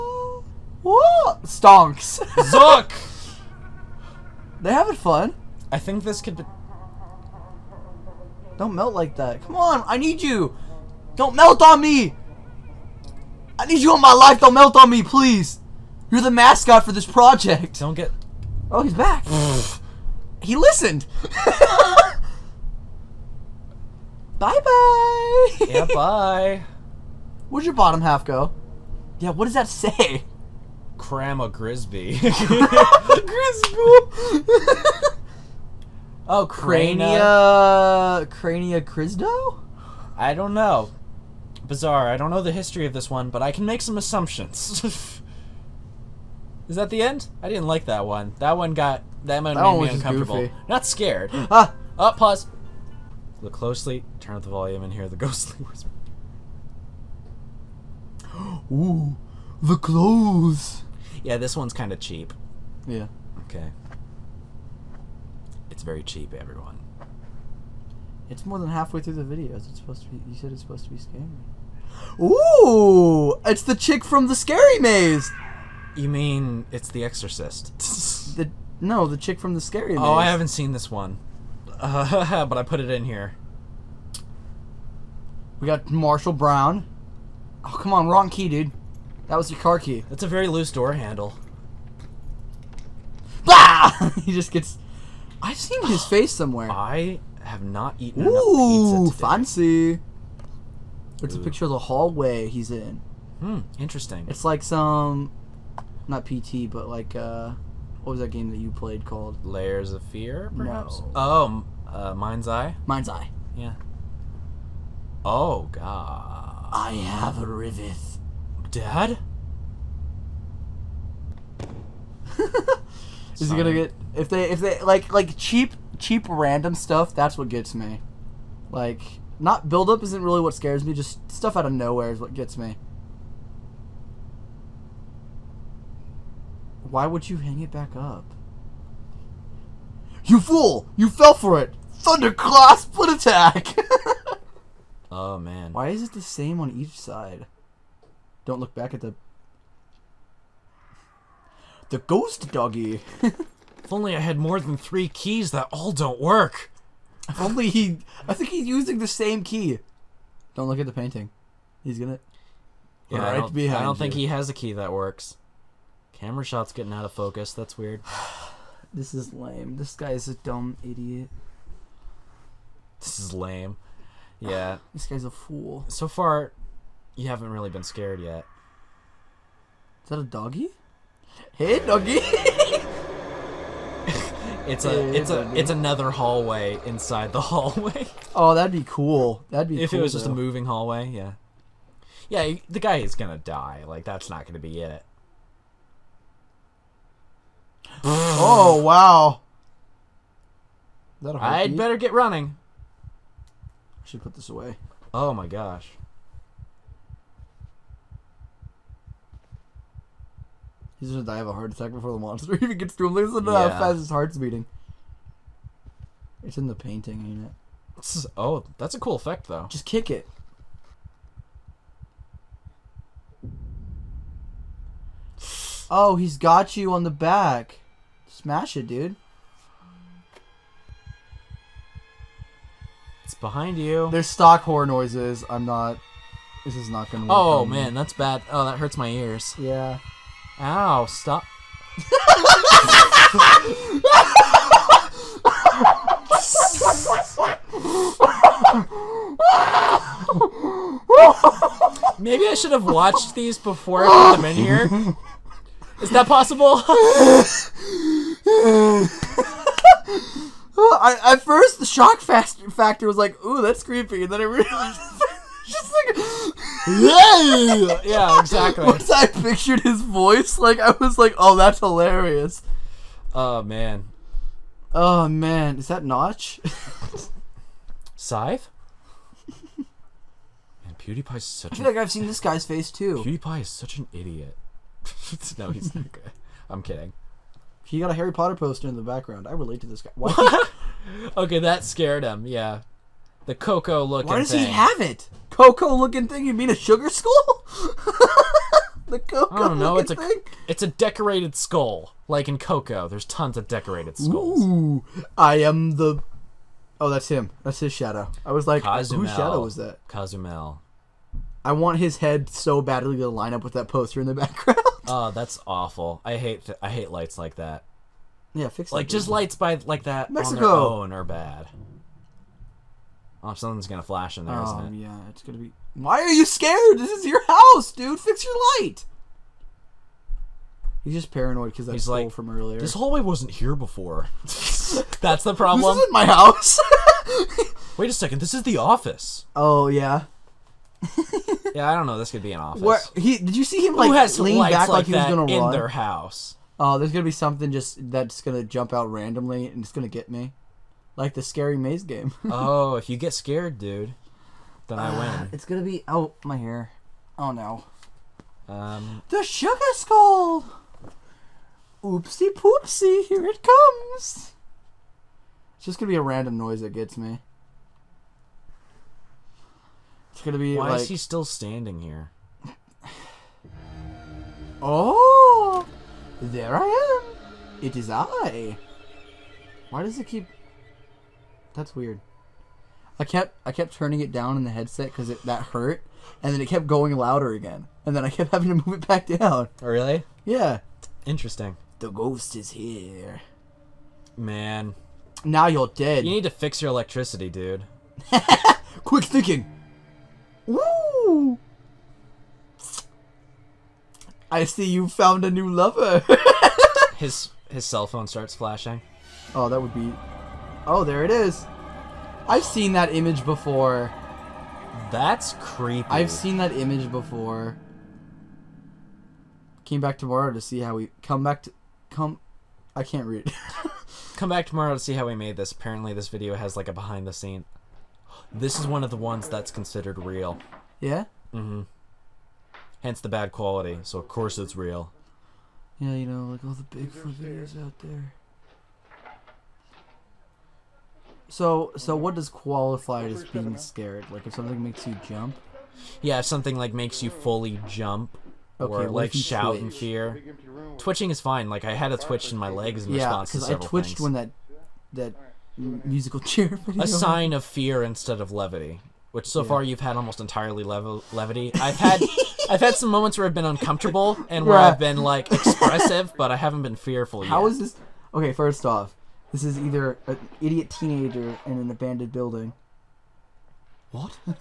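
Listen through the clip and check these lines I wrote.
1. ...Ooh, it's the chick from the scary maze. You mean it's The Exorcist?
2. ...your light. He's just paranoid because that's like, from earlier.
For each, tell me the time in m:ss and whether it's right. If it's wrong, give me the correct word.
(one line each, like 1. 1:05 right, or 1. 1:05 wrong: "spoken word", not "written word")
1. 1:12 right
2. 5:28 right.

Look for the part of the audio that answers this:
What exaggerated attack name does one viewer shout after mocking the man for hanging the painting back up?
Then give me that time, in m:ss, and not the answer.
2:22.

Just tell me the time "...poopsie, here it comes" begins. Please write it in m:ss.
6:02.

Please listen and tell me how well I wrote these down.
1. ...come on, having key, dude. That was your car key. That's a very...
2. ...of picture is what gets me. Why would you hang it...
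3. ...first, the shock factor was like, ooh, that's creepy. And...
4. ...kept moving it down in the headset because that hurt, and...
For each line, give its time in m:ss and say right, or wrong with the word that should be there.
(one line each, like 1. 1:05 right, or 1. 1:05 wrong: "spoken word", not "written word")
1. 1:27 wrong: "wrong", not "having"
2. 2:11 wrong: "nowhere", not "picture"
3. 4:21 right
4. 6:23 wrong: "turning", not "moving".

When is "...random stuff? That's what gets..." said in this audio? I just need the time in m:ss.
2:06.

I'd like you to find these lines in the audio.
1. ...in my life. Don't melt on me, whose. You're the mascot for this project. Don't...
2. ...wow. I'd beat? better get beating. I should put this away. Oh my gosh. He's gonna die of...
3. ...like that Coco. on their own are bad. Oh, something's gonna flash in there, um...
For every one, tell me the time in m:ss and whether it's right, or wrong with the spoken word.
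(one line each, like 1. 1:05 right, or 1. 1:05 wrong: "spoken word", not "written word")
1. 0:13 wrong: "please", not "whose"
2. 3:18 wrong: "running", not "beating"
3. 5:19 wrong: "Mexico", not "Coco".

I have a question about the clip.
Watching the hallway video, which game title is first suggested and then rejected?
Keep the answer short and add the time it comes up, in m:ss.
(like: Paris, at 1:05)
Layers of Fear, at 1:49.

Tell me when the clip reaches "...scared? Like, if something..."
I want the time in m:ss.
7:23.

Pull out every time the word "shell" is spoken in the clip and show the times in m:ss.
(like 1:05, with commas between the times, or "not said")
not said.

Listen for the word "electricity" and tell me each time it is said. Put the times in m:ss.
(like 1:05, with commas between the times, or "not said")
6:36.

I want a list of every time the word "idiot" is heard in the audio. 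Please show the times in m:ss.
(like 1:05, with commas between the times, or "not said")
2:50, 4:44, 7:50.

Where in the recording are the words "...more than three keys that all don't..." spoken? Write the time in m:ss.
2:34.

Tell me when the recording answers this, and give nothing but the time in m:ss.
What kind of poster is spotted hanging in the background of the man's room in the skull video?
4:48.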